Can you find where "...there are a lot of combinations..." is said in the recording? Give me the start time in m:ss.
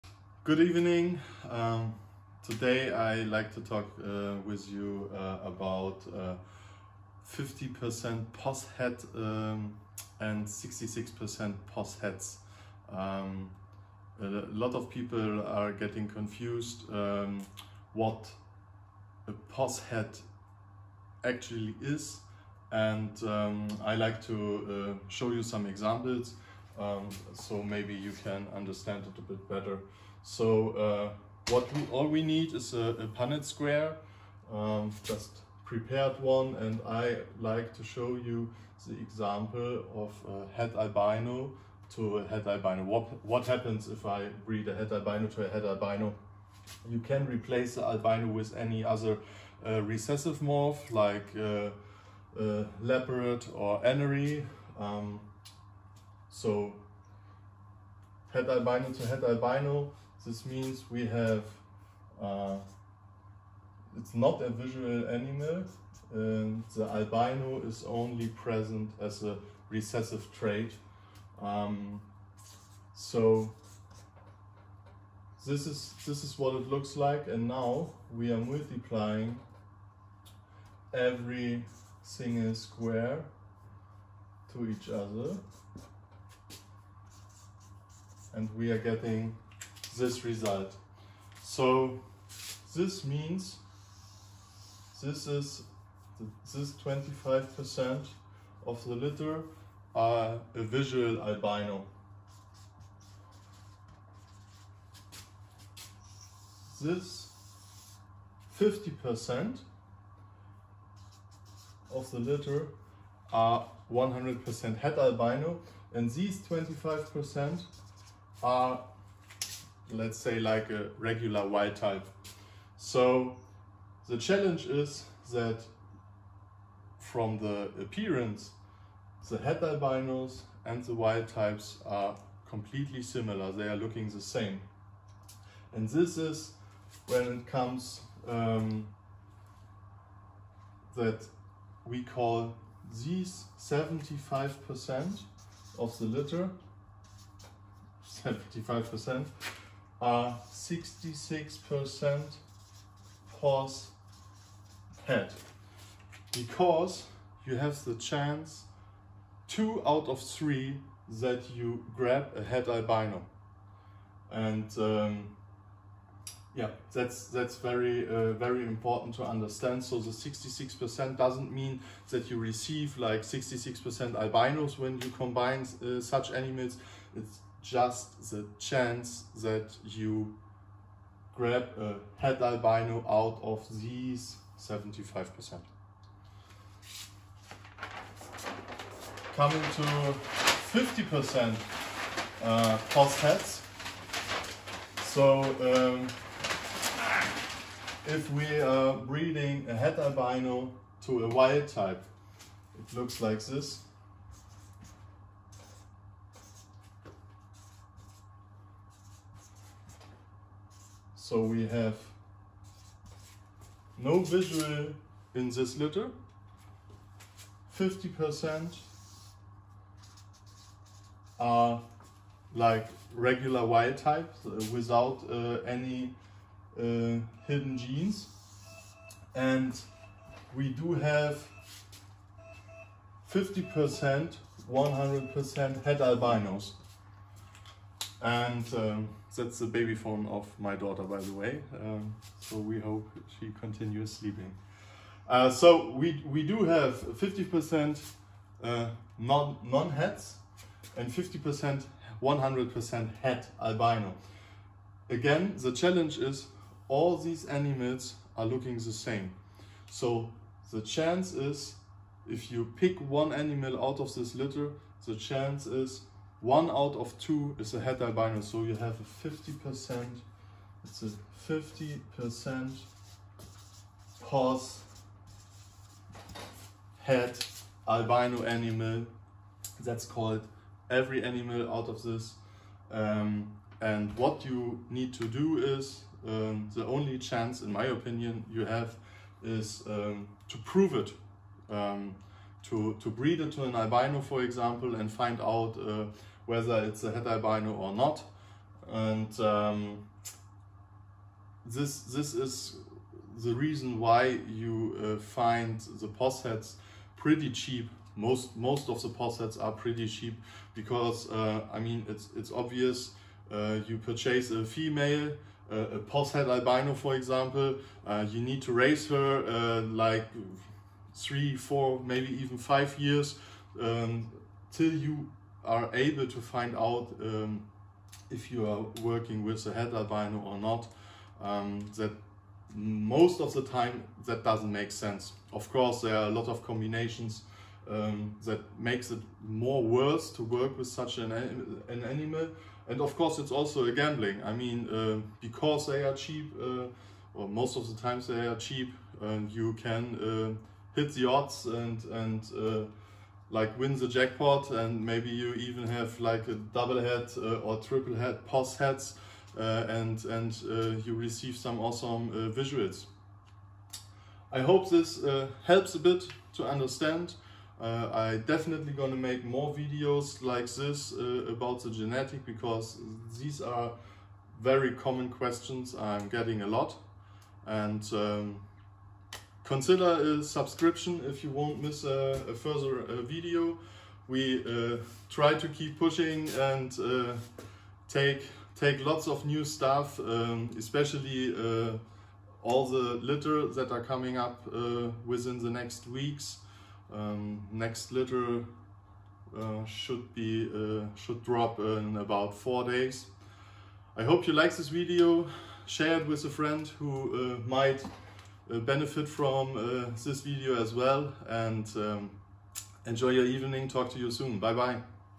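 5:36.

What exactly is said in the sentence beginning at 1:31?
So this means this is this 25% of the litter are a visual albino.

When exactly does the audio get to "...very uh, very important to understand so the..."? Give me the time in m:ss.
2:47.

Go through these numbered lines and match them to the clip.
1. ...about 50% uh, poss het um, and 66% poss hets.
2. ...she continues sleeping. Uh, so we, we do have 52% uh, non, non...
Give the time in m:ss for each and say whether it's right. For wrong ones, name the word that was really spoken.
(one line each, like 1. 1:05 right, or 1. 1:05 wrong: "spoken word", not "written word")
1. 0:05 right
2. 4:03 wrong: "50", not "52".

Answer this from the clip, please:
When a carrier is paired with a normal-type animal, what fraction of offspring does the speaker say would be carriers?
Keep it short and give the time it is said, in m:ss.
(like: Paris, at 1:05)
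1 out of 2, at 4:26.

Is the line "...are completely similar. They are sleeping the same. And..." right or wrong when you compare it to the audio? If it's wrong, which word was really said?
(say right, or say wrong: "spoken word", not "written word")
wrong: "looking", not "sleeping".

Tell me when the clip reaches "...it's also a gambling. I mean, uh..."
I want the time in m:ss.
5:43.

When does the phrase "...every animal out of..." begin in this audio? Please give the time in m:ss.
4:40.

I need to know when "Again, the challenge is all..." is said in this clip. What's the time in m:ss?
4:15.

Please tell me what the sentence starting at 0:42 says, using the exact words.
What, what happens if I breed a het albino to a het albino?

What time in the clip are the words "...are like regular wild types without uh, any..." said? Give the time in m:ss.
3:41.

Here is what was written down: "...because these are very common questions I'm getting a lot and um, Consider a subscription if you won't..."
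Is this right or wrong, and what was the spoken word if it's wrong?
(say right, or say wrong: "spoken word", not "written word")
right.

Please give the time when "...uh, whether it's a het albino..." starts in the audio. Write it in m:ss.
4:55.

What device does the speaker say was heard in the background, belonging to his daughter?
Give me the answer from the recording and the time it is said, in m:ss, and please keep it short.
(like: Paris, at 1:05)
baby phone, at 3:59.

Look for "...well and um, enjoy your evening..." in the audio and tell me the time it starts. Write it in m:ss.
6:50.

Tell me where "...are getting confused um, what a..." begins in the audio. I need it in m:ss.
0:15.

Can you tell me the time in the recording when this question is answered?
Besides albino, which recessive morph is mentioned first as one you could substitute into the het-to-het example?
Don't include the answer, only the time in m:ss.
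0:52.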